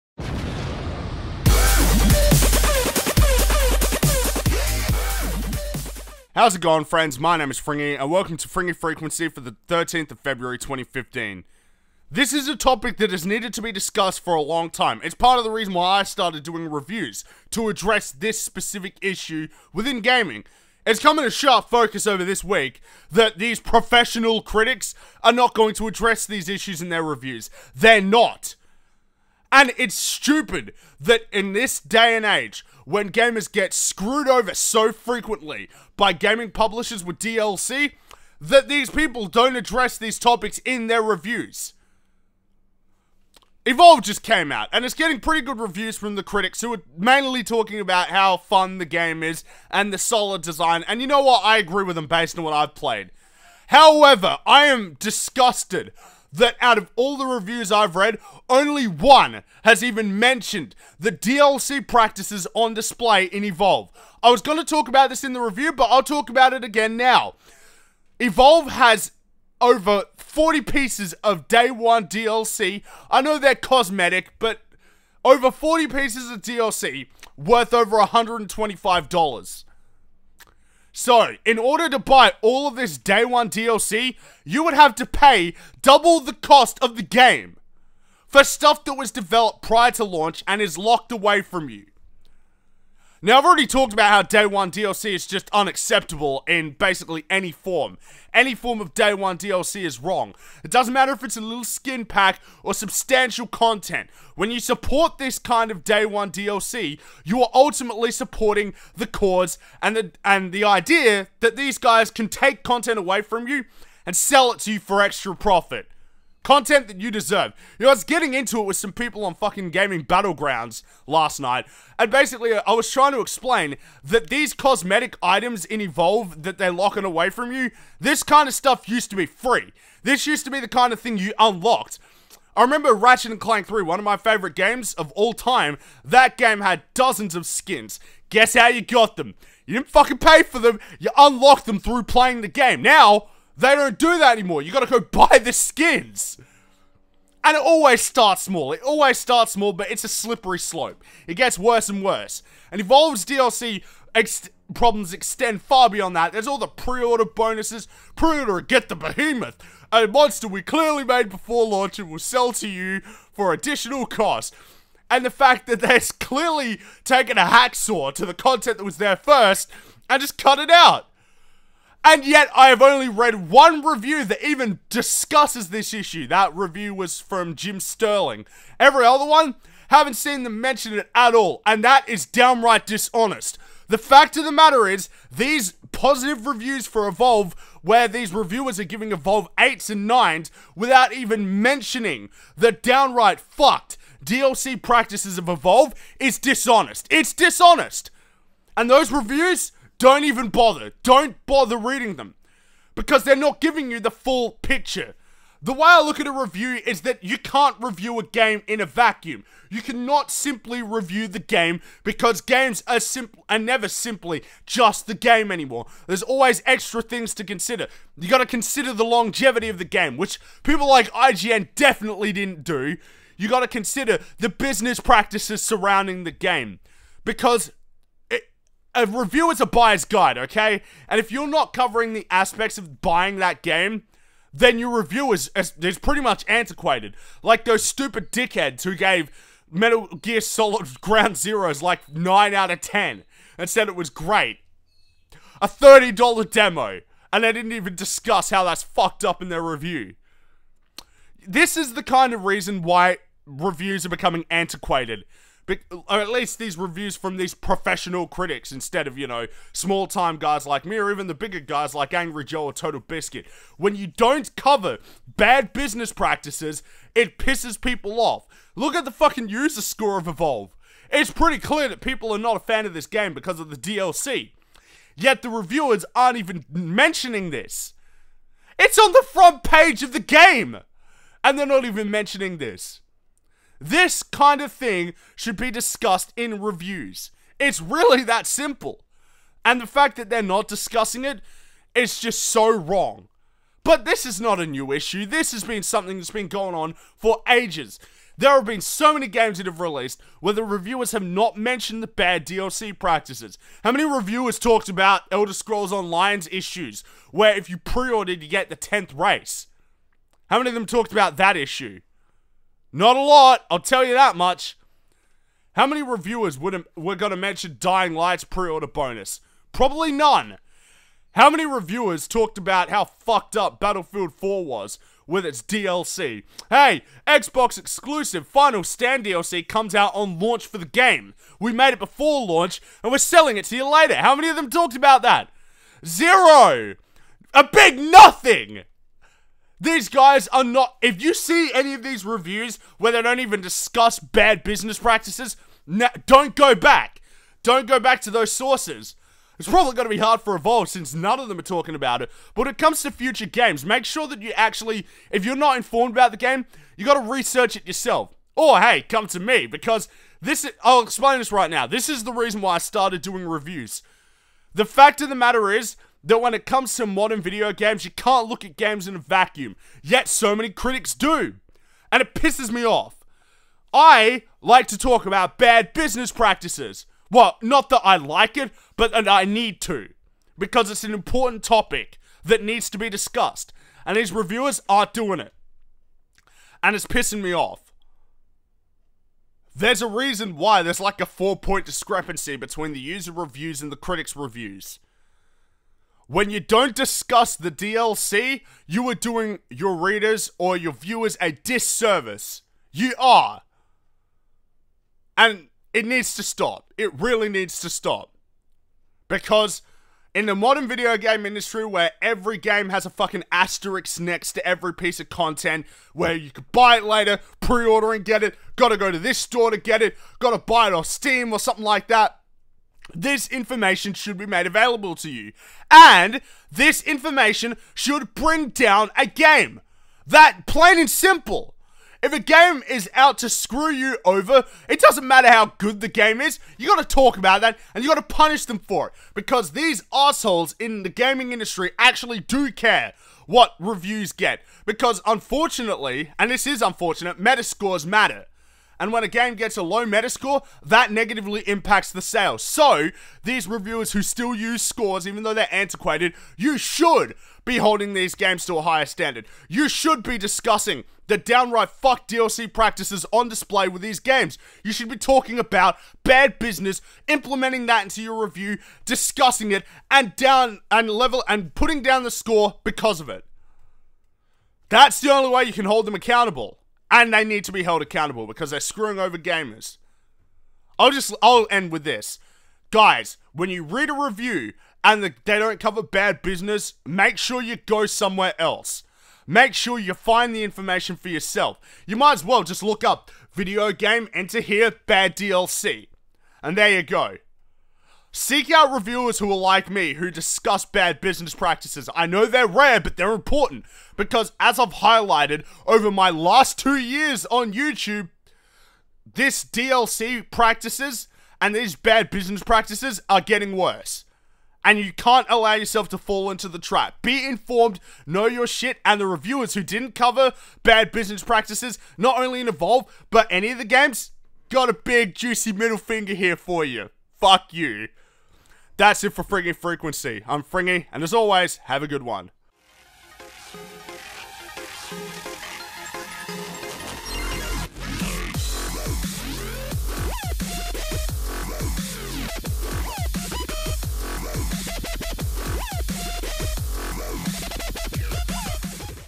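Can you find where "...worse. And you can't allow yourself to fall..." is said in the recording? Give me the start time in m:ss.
8:33.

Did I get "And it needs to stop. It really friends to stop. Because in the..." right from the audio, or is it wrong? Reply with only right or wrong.
wrong.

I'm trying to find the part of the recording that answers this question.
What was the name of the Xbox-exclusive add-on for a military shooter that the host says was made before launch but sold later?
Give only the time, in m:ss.
5:28.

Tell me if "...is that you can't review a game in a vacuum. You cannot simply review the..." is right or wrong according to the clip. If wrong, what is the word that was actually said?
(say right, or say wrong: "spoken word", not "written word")
right.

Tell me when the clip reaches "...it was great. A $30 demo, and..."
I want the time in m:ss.
4:03.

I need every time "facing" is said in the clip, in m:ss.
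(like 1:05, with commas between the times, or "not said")
not said.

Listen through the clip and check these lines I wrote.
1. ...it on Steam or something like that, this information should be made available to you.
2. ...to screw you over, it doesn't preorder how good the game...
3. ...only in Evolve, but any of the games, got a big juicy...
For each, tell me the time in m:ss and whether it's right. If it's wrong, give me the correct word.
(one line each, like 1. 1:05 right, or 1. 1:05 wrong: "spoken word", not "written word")
1. 7:00 right
2. 7:13 wrong: "matter", not "preorder"
3. 8:42 right.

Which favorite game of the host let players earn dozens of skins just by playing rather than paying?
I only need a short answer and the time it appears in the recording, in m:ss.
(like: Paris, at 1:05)
Ratchet and Clank 3, at 2:12.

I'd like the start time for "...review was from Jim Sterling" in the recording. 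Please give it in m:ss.
2:56.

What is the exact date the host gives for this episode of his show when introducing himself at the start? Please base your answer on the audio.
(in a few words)
13th of February 2015.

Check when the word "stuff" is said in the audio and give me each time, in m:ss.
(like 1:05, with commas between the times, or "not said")
1:28, 2:08.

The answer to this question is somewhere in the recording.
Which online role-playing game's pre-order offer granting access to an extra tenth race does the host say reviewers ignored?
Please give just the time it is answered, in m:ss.
5:05.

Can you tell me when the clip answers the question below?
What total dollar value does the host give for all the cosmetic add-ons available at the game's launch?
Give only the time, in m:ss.
1:17.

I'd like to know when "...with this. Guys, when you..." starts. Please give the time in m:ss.
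8:01.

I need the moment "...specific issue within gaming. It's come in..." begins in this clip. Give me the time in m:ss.
0:18.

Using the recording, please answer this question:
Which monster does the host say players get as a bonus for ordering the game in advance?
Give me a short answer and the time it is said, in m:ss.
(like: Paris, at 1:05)
Behemoth, at 2:38.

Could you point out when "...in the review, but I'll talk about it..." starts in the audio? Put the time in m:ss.
1:05.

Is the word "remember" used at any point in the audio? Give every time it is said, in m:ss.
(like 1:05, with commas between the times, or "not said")
2:12.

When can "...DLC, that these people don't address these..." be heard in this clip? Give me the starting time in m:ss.
0:37.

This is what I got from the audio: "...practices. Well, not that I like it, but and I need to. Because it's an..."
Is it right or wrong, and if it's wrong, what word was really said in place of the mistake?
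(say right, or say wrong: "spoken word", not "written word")
right.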